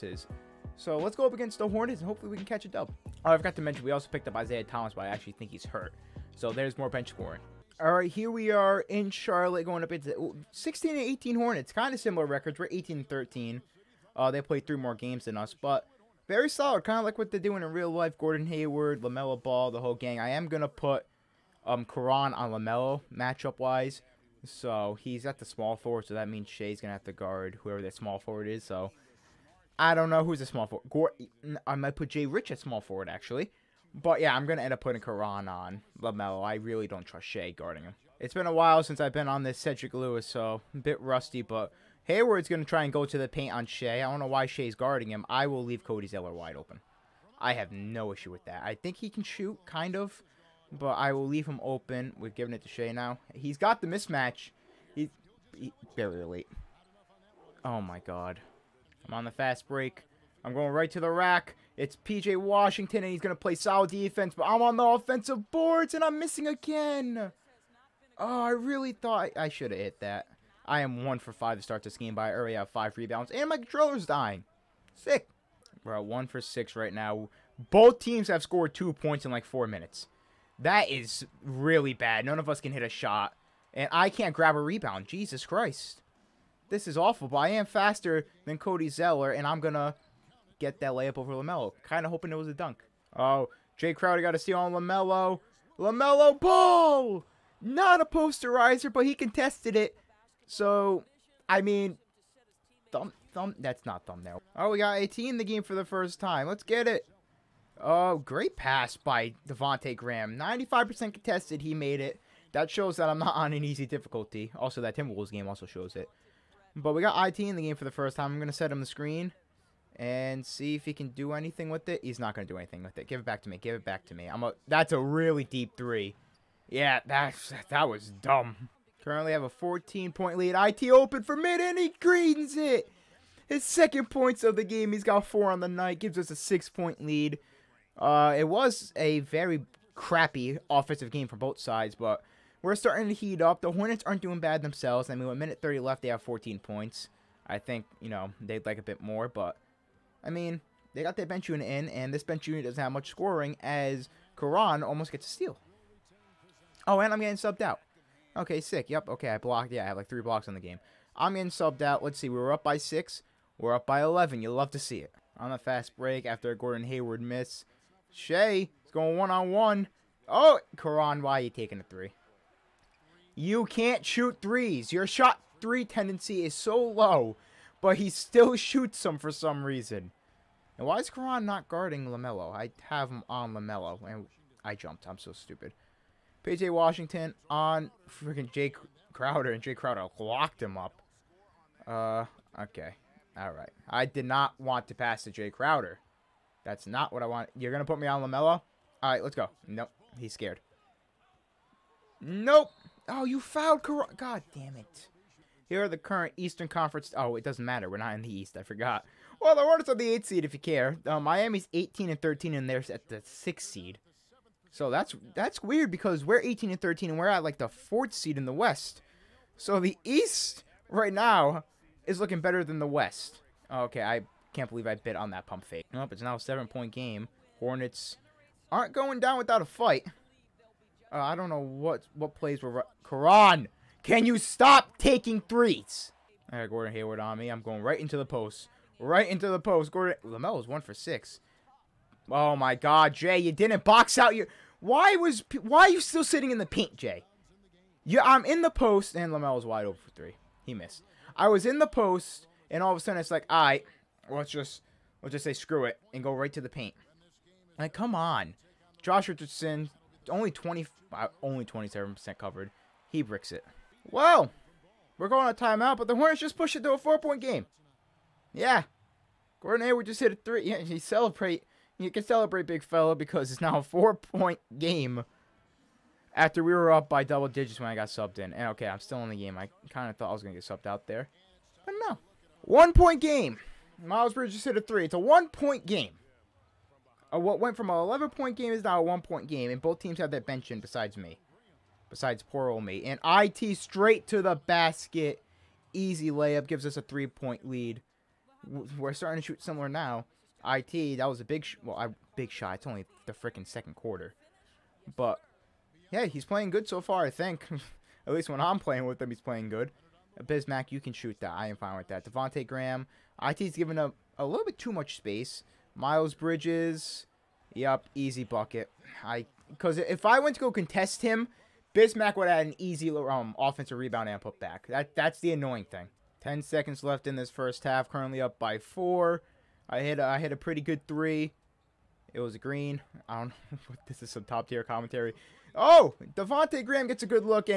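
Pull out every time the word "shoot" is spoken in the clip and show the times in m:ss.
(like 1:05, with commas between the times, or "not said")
0:49, 2:54, 2:58, 4:59, 5:11.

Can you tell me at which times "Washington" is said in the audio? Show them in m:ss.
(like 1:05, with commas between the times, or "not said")
1:02, 3:06.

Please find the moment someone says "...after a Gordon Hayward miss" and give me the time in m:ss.
2:46.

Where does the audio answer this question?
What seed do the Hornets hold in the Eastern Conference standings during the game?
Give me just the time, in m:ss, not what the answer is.
3:30.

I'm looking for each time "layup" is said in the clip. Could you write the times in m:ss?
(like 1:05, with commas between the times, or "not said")
1:30, 4:56.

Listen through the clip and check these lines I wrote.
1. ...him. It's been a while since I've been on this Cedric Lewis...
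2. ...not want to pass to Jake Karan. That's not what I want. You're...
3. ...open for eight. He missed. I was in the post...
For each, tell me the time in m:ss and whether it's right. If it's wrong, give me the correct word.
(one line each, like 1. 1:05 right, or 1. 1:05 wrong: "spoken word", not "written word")
1. 0:37 right
2. 3:14 wrong: "Crowder", not "Karan"
3. 4:09 wrong: "three", not "eight".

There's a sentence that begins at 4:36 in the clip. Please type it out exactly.
After we were up by double digits when I got subbed in.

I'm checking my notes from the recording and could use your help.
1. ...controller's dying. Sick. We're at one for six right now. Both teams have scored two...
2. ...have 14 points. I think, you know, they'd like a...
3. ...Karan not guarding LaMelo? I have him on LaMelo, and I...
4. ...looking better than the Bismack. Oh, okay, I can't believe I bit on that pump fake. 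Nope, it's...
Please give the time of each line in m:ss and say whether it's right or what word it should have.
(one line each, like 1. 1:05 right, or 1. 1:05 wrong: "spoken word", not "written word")
1. 1:13 right
2. 2:26 right
3. 3:01 right
4. 3:42 wrong: "West", not "Bismack".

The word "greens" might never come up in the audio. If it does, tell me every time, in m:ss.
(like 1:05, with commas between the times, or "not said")
2:11, 5:32.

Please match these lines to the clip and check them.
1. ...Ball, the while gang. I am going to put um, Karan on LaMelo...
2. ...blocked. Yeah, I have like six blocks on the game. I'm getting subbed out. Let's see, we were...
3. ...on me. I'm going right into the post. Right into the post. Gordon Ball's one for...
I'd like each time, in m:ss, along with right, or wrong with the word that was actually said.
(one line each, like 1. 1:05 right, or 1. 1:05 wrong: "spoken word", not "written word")
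1. 0:19 wrong: "whole", not "while"
2. 2:39 wrong: "three", not "six"
3. 3:57 wrong: "Lamelo", not "Ball".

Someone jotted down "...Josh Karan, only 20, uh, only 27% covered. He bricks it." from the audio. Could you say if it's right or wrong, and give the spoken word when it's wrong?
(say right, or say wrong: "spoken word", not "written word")
wrong: "Richardson", not "Karan".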